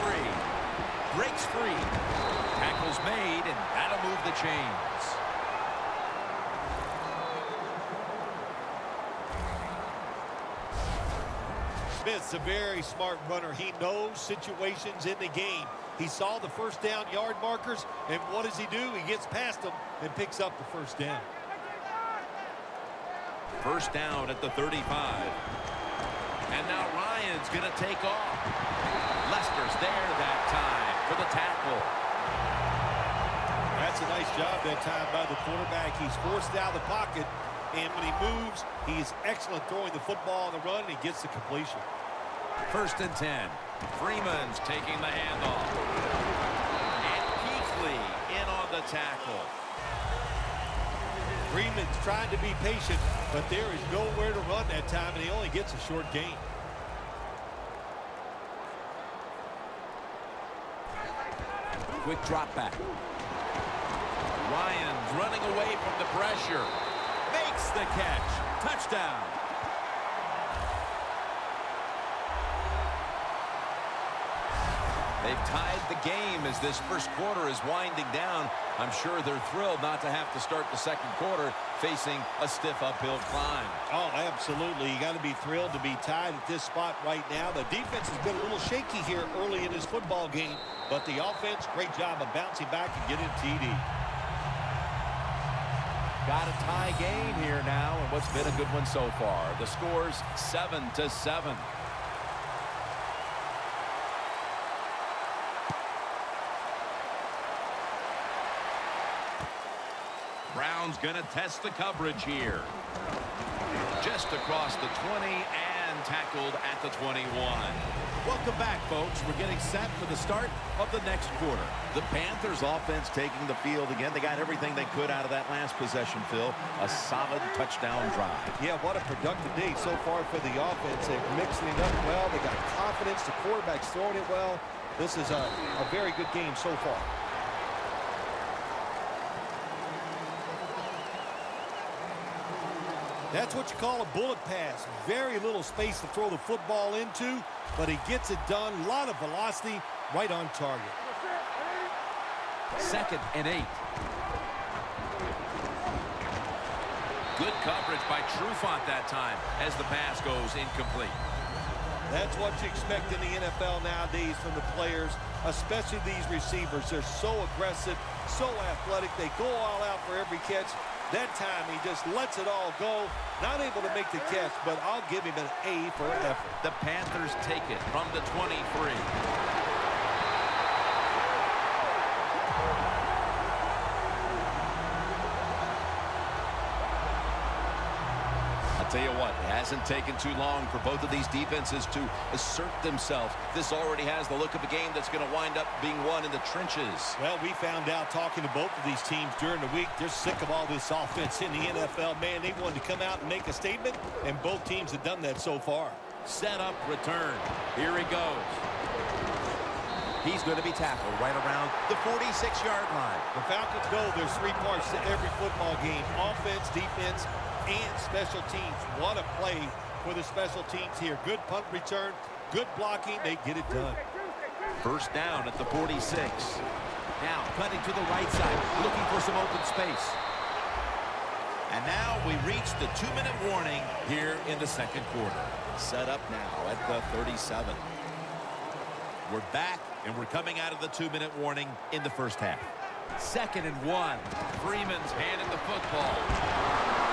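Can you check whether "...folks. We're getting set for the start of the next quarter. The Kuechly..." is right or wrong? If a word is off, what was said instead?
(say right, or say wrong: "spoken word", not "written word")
wrong: "Panthers", not "Kuechly".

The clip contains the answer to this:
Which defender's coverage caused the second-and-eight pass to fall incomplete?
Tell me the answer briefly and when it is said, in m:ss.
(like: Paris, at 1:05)
Trufant, at 2:38.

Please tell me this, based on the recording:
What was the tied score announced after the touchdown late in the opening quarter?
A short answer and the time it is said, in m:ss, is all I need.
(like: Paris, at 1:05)
7 to 7, at 1:40.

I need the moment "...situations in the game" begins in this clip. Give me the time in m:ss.
0:14.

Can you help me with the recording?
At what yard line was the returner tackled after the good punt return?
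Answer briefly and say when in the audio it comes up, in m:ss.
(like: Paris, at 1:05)
46, at 3:32.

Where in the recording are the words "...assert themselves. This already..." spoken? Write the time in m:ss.
3:12.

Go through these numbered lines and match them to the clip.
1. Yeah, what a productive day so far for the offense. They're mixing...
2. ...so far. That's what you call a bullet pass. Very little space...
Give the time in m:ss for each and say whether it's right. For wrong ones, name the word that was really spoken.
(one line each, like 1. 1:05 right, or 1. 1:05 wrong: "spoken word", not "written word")
1. 2:08 right
2. 2:16 right.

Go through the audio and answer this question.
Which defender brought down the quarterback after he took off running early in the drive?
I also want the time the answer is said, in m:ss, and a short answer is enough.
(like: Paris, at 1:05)
Lester, at 0:29.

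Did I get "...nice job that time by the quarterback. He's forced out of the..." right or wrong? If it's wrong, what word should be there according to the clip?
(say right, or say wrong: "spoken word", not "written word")
right.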